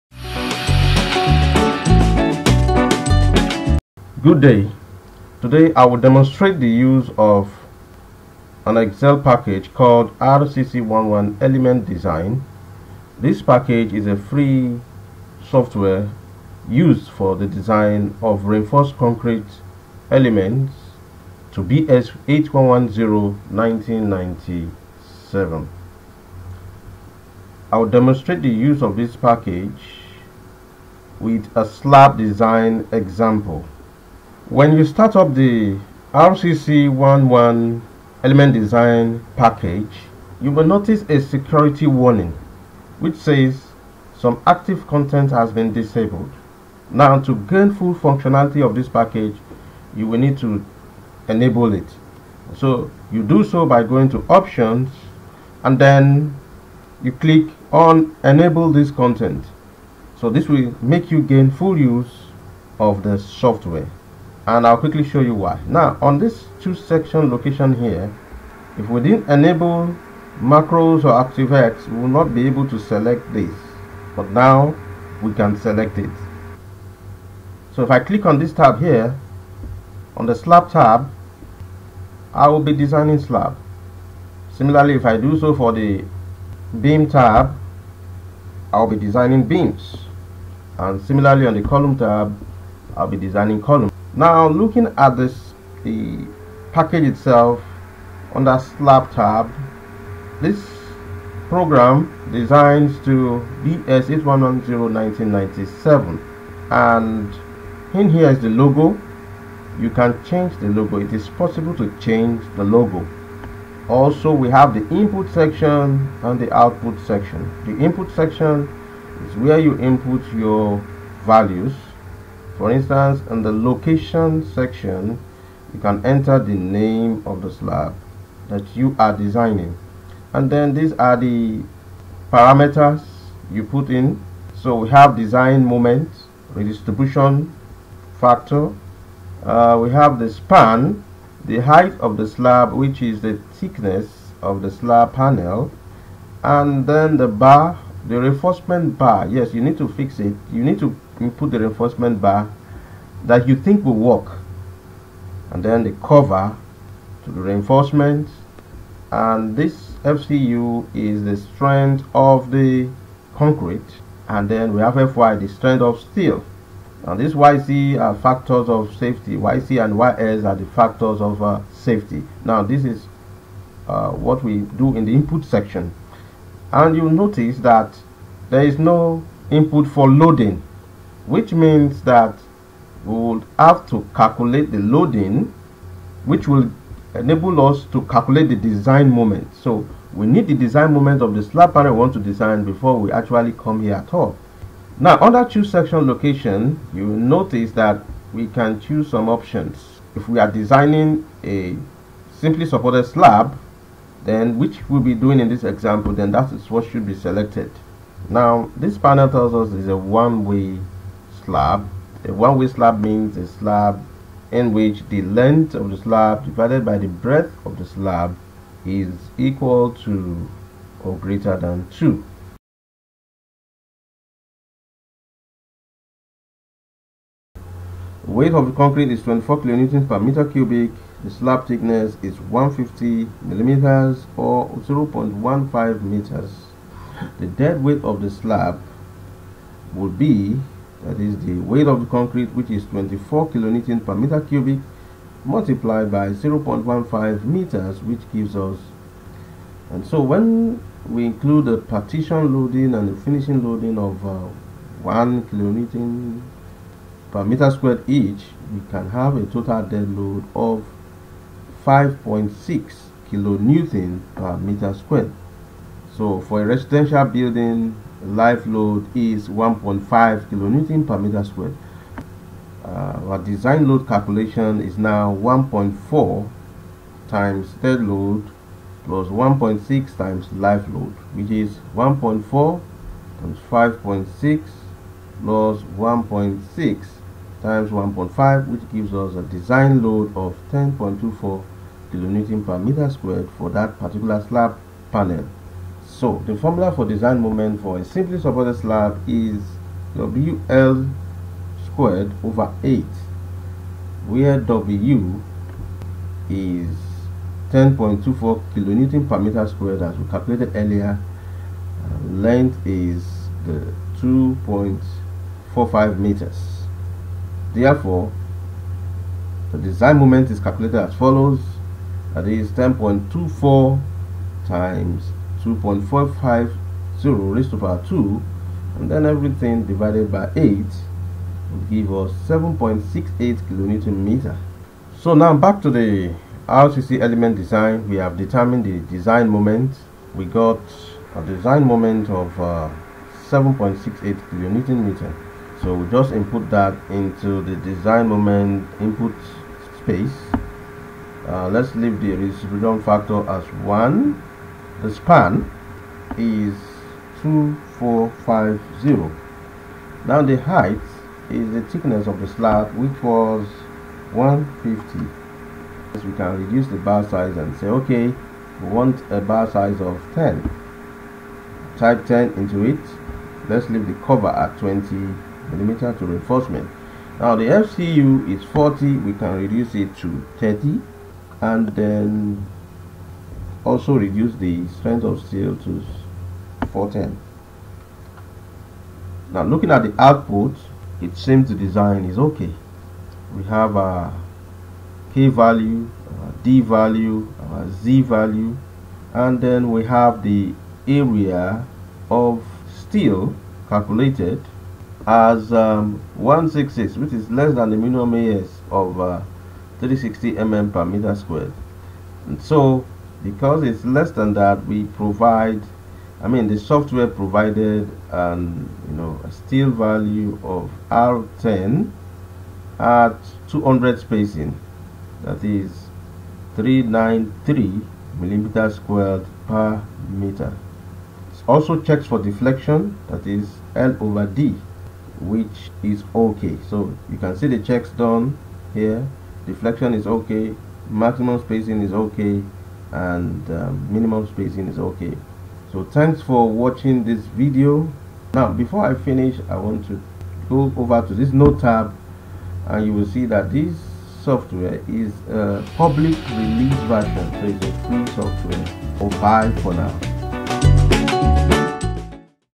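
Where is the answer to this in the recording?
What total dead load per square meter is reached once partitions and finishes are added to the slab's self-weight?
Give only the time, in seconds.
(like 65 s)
261 s.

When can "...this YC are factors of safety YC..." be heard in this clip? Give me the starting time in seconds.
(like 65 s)
167 s.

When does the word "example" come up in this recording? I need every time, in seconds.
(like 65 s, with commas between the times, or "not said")
32 s, 205 s.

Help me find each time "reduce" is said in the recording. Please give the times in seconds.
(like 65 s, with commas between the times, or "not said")
366 s, 379 s, 384 s.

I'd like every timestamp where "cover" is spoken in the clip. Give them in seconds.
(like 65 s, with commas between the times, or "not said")
156 s, 374 s.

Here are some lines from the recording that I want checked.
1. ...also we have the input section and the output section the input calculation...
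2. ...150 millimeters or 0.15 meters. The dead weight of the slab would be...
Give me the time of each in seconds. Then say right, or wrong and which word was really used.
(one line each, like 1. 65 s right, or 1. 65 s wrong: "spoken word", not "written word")
1. 113 s wrong: "section", not "calculation"
2. 232 s right.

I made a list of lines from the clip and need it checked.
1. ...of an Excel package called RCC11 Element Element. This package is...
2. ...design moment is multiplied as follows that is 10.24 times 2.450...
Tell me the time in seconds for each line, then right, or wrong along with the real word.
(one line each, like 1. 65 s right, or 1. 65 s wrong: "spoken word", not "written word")
1. 7 s wrong: "Design", not "Element"
2. 319 s wrong: "calculated", not "multiplied".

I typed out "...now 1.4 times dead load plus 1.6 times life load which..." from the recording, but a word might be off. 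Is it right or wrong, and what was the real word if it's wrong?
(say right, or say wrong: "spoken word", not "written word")
right.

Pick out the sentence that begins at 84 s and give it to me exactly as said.
Similarly, if I do so for the beam tab, I'll be designing beams.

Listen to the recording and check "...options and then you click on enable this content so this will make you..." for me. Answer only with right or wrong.
right.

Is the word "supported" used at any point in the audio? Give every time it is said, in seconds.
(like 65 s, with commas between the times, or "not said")
202 s, 298 s.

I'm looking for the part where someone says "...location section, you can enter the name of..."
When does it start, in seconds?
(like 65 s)
123 s.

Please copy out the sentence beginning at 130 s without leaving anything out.
And then these are the parameters you put in.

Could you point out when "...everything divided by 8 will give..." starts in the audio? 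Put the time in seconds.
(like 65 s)
329 s.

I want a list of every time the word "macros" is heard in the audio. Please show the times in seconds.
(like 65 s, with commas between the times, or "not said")
70 s.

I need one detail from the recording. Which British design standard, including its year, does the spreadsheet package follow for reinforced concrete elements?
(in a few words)
BS 8110-1997.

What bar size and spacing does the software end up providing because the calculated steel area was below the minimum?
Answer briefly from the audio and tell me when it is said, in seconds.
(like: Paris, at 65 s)
R10 at 200, at 421 s.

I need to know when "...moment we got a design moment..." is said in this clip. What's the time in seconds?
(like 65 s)
339 s.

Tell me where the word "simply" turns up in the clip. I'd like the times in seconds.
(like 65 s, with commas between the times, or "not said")
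202 s, 298 s.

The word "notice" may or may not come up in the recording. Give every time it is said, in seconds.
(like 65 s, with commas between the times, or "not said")
40 s, 177 s, 197 s.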